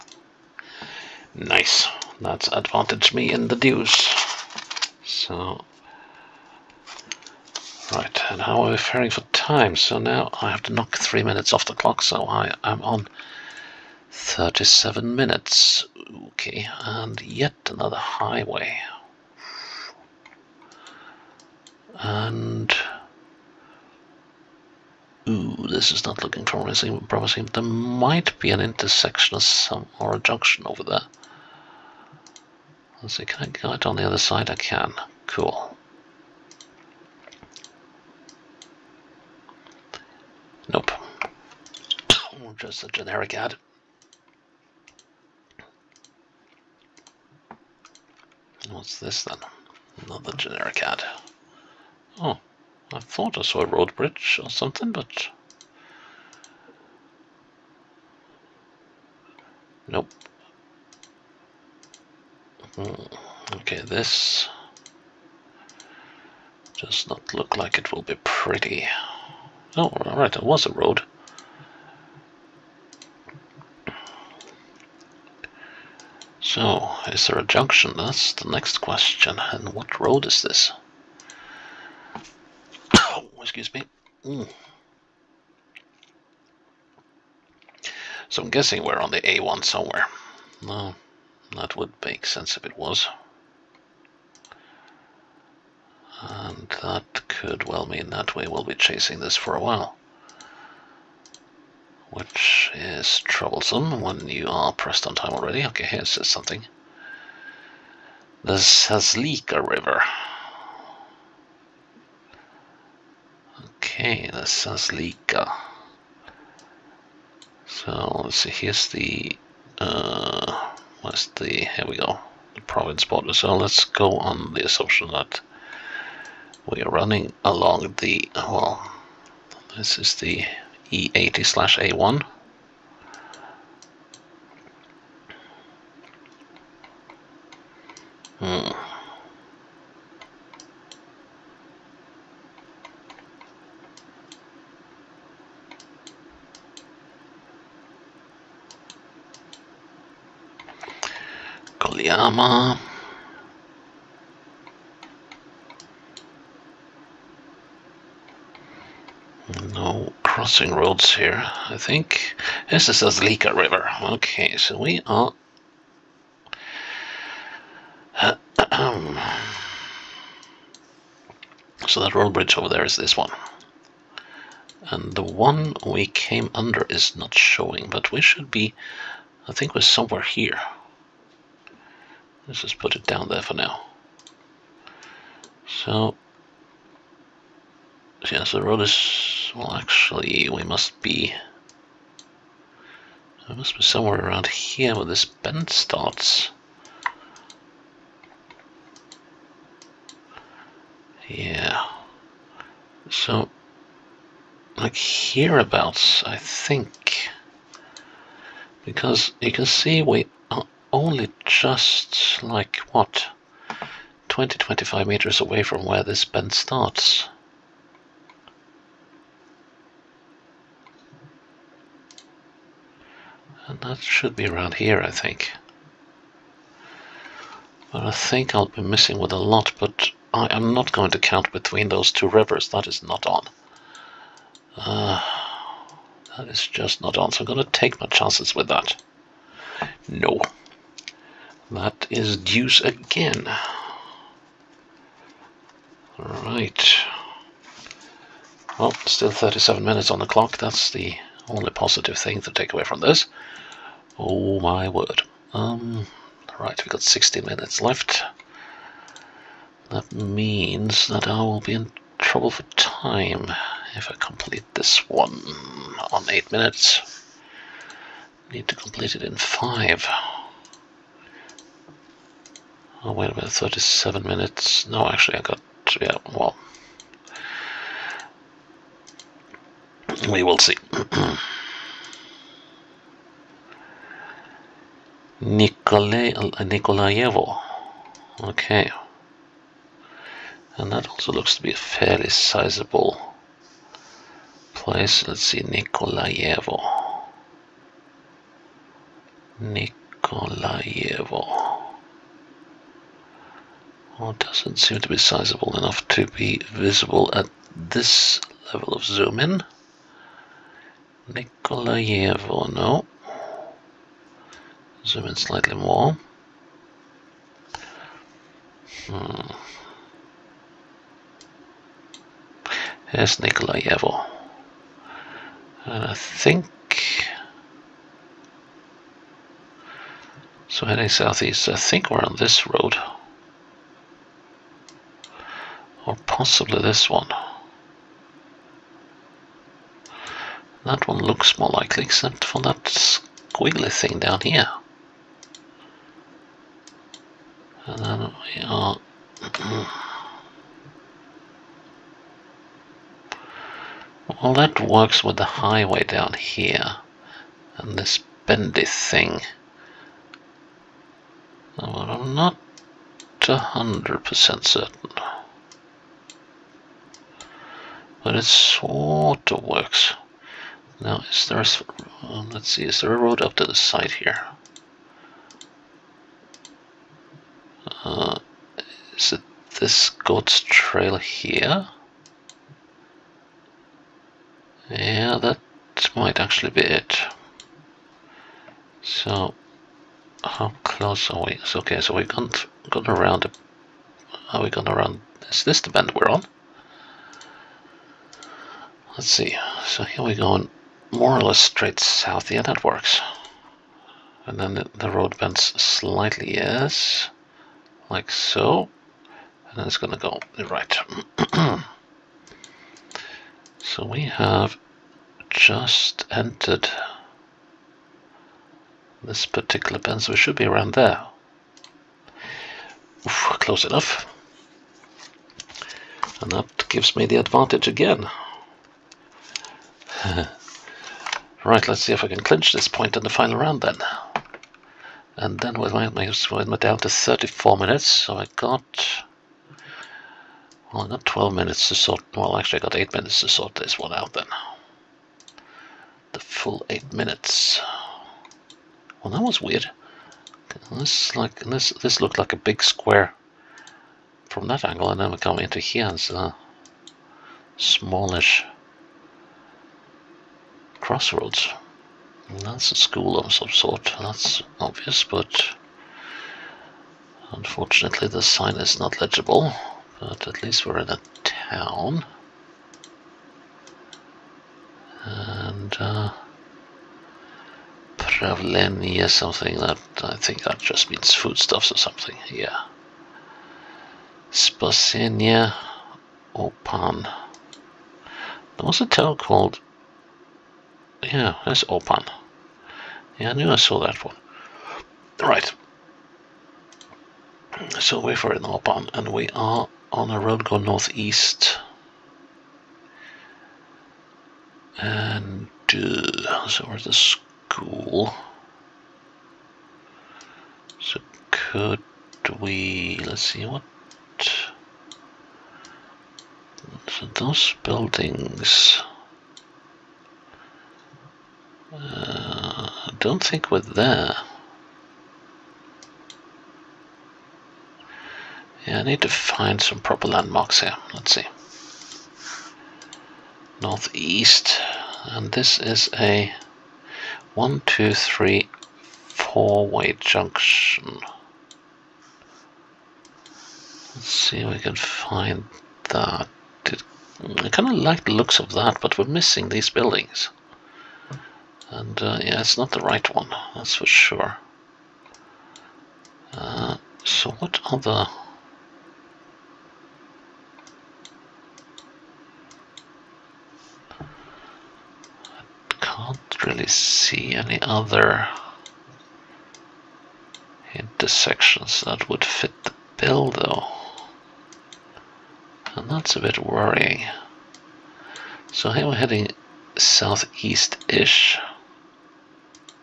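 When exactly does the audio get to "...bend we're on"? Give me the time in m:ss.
6:35.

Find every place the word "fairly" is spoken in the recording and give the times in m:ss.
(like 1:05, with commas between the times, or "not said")
4:51.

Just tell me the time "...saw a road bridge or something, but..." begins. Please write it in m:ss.
0:53.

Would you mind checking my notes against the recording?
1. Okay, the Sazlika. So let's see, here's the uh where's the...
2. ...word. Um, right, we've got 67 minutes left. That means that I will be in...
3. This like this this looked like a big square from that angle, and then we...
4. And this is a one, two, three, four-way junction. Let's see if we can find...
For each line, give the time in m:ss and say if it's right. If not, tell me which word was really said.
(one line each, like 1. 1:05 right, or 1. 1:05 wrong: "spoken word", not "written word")
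1. 1:53 right
2. 4:14 wrong: "60", not "67"
3. 7:30 right
4. 8:55 right.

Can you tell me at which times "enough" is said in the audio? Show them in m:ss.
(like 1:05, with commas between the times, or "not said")
5:05, 7:03.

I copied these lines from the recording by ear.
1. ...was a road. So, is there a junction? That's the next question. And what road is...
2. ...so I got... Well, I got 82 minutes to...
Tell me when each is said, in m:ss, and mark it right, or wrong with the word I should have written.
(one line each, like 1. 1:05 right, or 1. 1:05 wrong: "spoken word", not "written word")
1. 1:10 right
2. 7:18 wrong: "12", not "82".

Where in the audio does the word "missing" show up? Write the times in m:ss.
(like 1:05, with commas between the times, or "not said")
3:48, 9:09.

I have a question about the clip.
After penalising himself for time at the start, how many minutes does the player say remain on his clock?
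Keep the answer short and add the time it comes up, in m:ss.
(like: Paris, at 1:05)
37 minutes, at 0:12.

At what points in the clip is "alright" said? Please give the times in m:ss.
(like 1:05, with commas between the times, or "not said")
1:10, 4:06.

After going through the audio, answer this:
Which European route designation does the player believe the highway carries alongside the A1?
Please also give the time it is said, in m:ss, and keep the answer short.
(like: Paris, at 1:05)
E80, at 2:10.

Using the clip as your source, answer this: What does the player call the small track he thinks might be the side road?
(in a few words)
goat's trail.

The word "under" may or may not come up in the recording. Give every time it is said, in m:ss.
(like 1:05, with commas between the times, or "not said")
2:56.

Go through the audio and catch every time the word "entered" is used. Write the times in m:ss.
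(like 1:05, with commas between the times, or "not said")
6:56.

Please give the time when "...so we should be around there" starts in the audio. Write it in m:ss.
7:00.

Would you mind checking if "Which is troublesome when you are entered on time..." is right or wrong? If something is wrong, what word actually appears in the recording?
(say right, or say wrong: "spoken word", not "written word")
wrong: "pressed", not "entered".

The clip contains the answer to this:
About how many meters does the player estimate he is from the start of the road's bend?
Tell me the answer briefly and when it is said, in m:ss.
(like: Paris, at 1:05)
20-25 meters, at 3:34.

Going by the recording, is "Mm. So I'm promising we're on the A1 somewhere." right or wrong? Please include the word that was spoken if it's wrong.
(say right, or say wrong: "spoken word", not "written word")
wrong: "guessing", not "promising".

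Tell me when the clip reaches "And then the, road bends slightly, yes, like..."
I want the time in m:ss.
6:44.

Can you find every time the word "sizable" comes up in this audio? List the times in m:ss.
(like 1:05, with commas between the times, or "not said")
4:52, 5:05.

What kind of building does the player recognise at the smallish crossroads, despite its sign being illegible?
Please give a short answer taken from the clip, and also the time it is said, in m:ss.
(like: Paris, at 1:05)
A school, at 7:42.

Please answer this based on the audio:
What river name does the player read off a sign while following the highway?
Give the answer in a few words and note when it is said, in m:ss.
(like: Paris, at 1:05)
Sazlika River, at 1:48.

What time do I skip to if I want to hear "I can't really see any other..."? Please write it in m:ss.
9:24.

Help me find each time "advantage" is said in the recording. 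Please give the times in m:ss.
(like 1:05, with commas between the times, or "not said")
0:02, 7:07.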